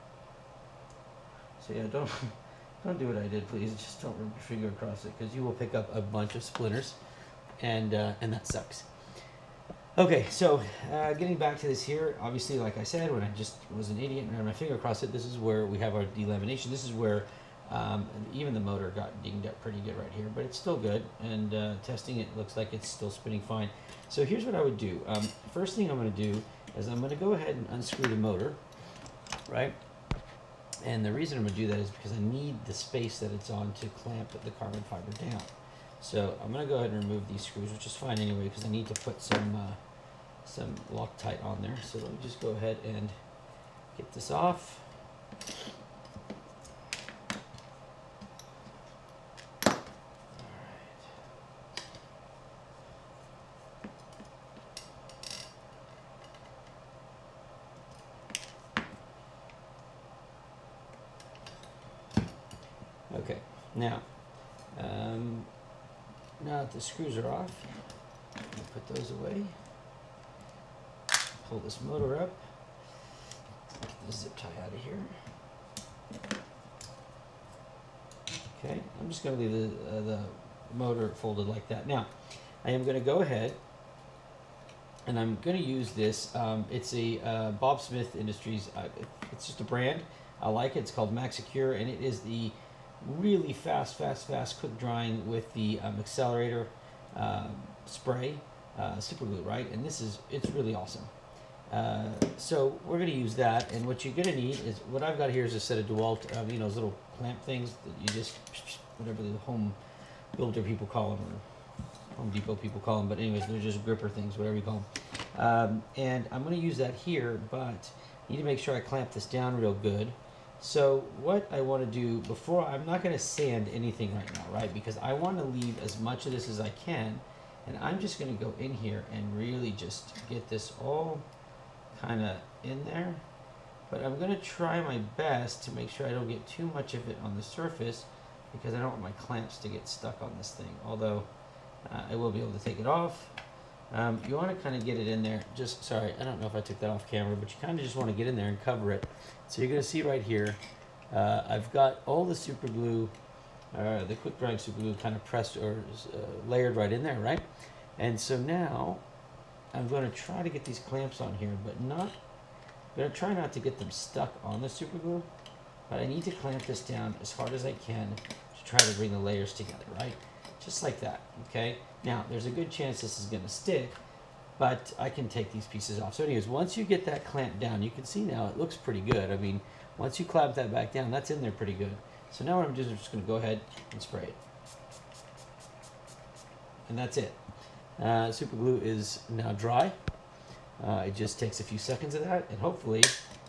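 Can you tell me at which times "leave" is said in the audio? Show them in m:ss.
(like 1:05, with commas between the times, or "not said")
1:19, 2:05.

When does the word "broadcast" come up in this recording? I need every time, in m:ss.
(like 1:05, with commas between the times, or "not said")
not said.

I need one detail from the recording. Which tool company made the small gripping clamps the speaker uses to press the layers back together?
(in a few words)
DeWalt.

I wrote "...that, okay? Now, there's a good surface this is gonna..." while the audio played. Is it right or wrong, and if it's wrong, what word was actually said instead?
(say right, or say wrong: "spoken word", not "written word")
wrong: "chance", not "surface".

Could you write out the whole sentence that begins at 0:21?
And uh, testing it looks like it's still spinning fine.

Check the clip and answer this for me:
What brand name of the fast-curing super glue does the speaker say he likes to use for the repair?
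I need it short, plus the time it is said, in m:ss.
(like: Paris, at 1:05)
Maxi-Cure, at 1:31.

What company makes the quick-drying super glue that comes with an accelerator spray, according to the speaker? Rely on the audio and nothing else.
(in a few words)
Bob Smith Industries.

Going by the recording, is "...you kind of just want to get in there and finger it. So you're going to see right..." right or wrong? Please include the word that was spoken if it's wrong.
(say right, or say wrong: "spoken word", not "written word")
wrong: "cover", not "finger".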